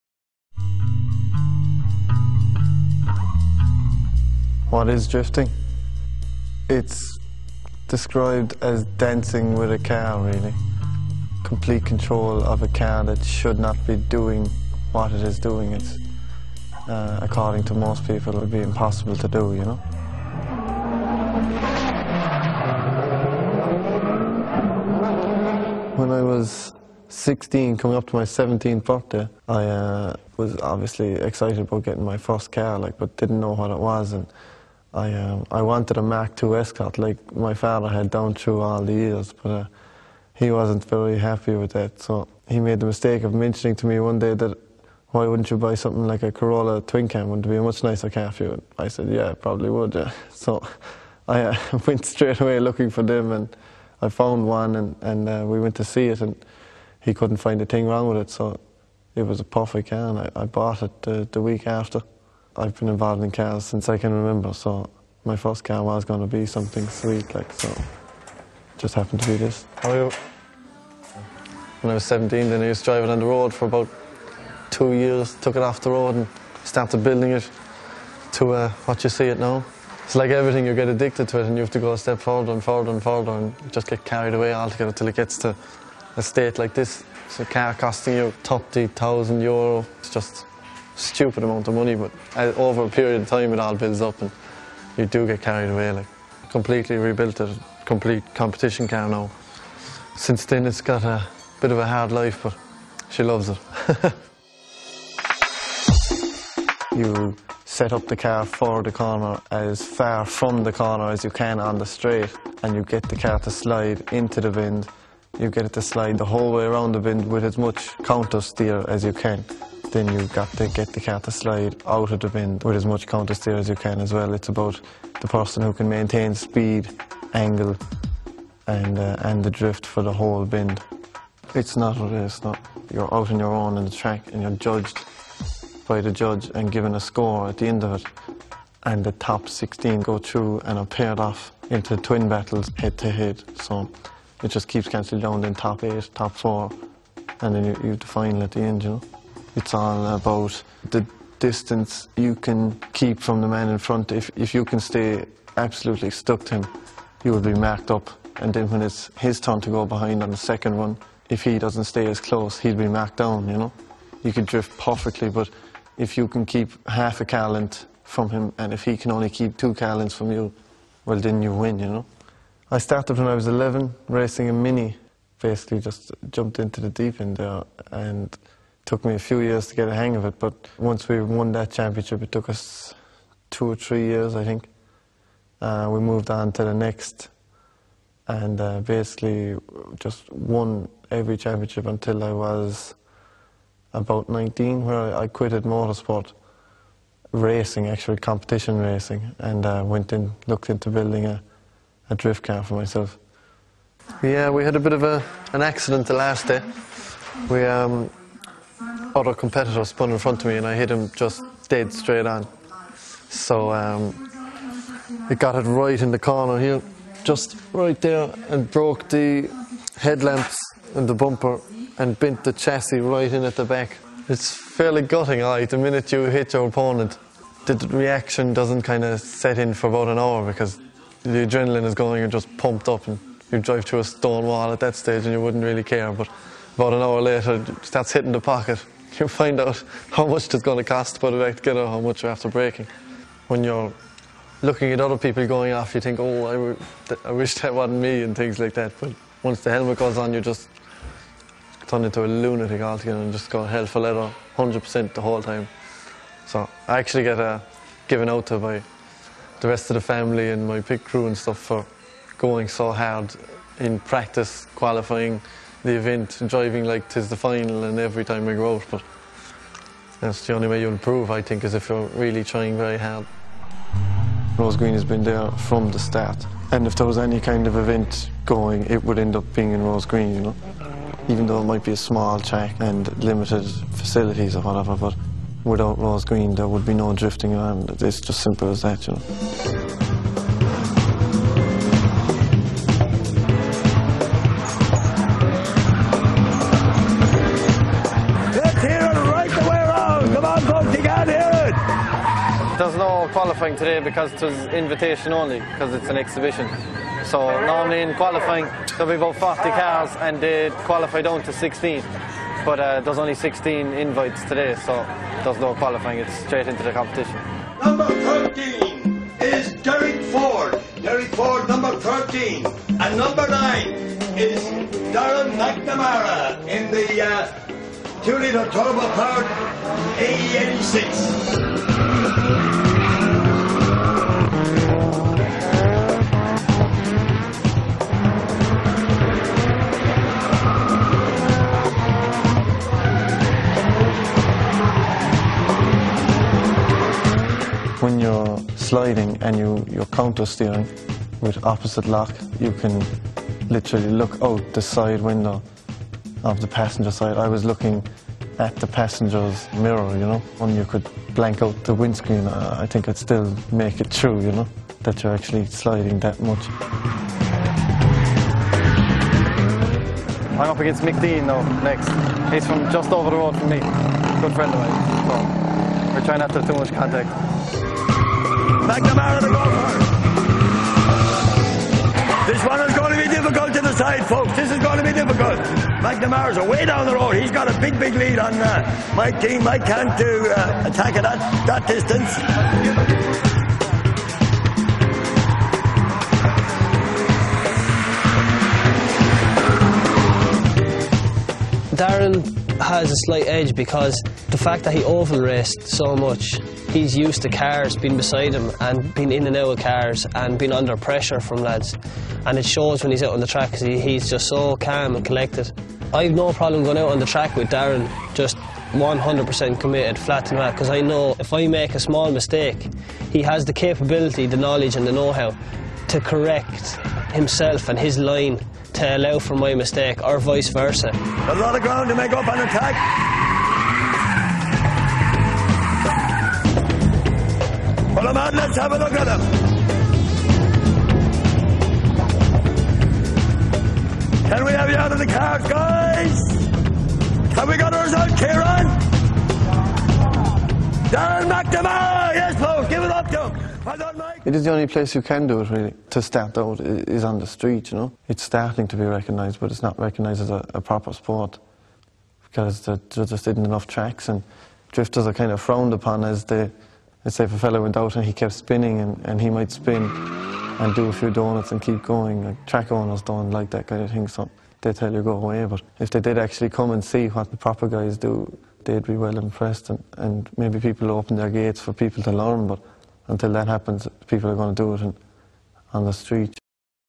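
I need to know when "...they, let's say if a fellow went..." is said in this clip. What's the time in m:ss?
7:46.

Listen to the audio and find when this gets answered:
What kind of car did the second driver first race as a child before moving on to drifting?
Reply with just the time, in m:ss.
2:54.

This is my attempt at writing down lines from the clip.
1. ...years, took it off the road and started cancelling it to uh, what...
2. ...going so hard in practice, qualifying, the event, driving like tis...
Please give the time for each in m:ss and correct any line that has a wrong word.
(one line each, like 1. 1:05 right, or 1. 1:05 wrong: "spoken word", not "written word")
1. 1:14 wrong: "building", not "cancelling"
2. 4:22 right.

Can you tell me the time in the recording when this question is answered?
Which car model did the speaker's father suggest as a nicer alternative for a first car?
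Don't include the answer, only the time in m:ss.
0:46.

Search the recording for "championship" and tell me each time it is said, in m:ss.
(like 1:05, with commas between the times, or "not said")
3:01, 3:11.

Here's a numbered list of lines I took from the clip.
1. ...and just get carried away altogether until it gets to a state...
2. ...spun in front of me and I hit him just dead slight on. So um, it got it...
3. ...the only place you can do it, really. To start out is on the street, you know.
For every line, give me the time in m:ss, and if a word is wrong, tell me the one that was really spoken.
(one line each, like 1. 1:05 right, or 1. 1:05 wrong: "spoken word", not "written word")
1. 1:23 right
2. 3:29 wrong: "straight", not "slight"
3. 7:34 right.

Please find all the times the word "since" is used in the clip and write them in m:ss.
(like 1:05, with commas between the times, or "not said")
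1:03, 1:40.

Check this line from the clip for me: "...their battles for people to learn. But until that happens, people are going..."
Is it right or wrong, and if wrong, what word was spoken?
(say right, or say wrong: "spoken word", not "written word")
wrong: "gates", not "battles".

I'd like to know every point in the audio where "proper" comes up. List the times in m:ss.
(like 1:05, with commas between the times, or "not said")
7:40, 7:57.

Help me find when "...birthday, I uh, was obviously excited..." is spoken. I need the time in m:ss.
0:28.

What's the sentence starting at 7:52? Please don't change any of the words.
Like, track owners don't like that kind of thing, so they tell you go away.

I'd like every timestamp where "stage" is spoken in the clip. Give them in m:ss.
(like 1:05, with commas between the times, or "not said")
3:54.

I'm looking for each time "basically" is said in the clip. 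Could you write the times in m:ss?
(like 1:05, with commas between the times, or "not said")
2:55, 3:08.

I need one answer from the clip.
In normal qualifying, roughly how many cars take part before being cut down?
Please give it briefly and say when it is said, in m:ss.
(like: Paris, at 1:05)
40, at 5:09.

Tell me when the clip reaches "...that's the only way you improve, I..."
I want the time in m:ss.
4:30.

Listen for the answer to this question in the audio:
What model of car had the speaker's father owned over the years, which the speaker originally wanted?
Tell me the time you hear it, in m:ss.
0:36.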